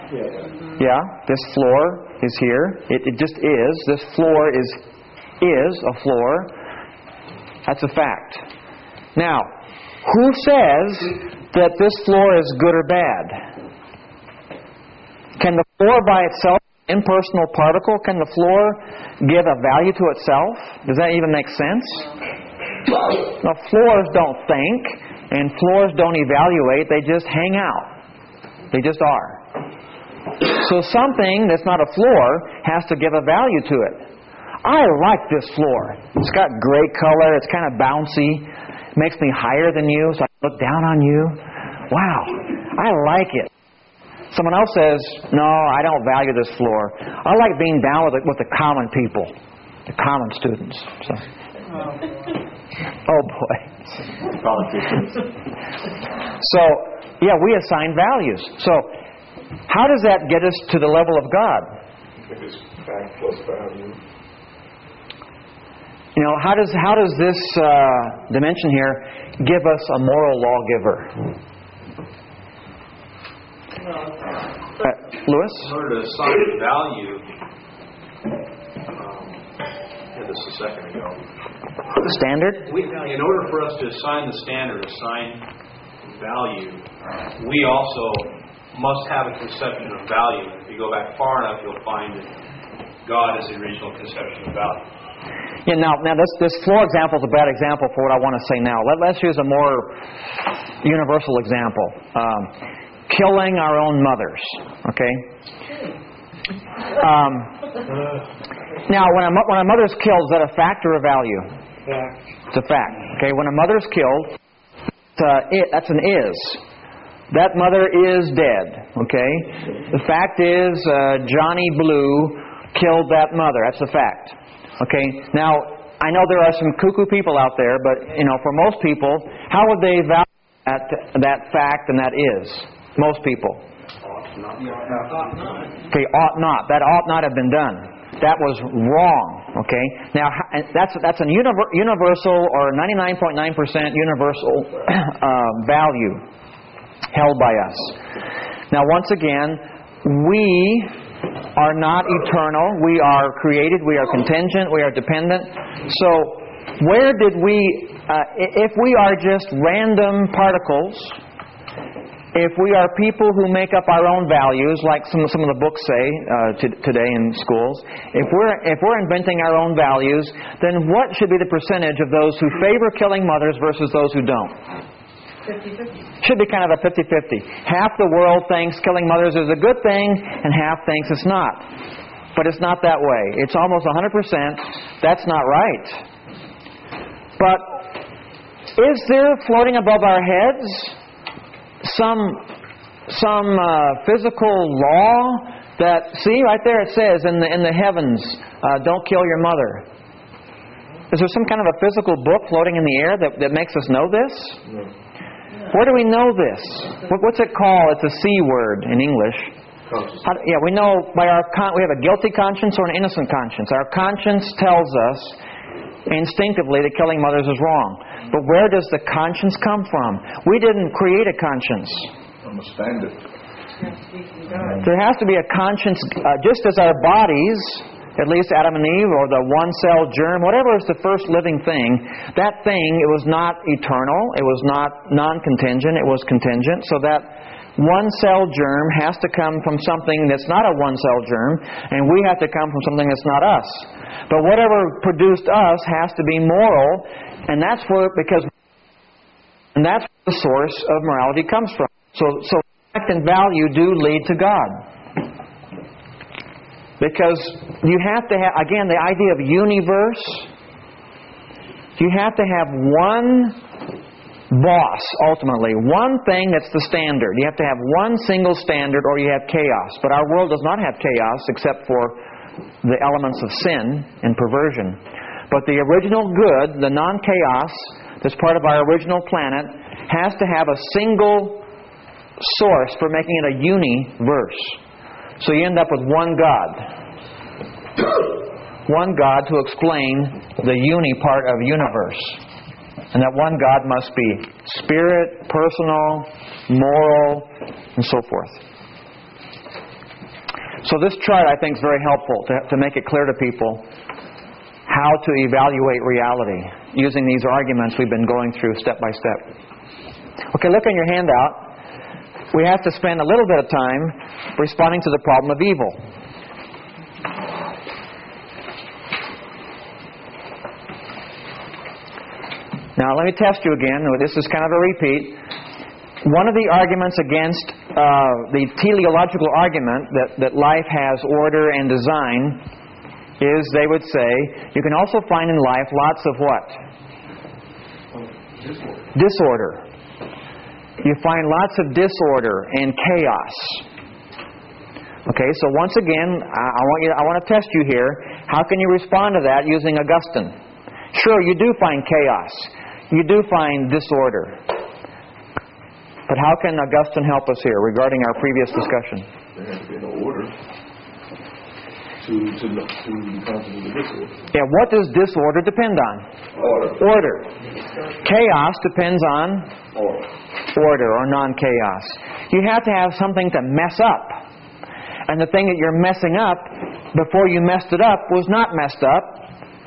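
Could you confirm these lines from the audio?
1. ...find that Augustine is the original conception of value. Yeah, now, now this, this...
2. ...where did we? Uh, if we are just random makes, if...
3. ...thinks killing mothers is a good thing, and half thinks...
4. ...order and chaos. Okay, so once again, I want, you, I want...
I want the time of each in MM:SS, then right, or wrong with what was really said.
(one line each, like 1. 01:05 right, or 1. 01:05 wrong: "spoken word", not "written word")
1. 01:31 wrong: "God", not "Augustine"
2. 02:36 wrong: "particles", not "makes"
3. 02:58 right
4. 05:41 wrong: "disorder", not "order".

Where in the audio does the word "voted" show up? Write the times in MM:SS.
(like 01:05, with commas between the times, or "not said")
not said.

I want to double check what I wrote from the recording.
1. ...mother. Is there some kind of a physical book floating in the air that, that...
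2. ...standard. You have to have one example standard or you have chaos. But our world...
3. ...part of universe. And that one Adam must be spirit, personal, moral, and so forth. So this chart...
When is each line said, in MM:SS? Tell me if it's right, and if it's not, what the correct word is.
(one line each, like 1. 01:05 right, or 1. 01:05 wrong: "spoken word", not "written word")
1. 03:19 right
2. 04:26 wrong: "single", not "example"
3. 04:51 wrong: "God", not "Adam".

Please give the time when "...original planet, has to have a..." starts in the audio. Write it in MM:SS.
04:38.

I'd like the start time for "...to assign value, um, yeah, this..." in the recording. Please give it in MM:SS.
01:15.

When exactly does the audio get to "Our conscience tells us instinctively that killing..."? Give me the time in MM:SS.
03:33.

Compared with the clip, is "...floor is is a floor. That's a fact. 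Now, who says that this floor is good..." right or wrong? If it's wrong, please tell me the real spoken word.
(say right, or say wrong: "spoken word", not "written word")
right.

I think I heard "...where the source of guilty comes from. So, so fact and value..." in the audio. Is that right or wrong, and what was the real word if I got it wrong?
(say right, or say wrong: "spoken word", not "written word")
wrong: "morality", not "guilty".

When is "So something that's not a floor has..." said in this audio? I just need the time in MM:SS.
00:30.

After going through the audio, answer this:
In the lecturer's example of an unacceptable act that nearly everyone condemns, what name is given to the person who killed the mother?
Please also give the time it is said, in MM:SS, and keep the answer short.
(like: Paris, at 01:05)
Johnny Blue, at 02:01.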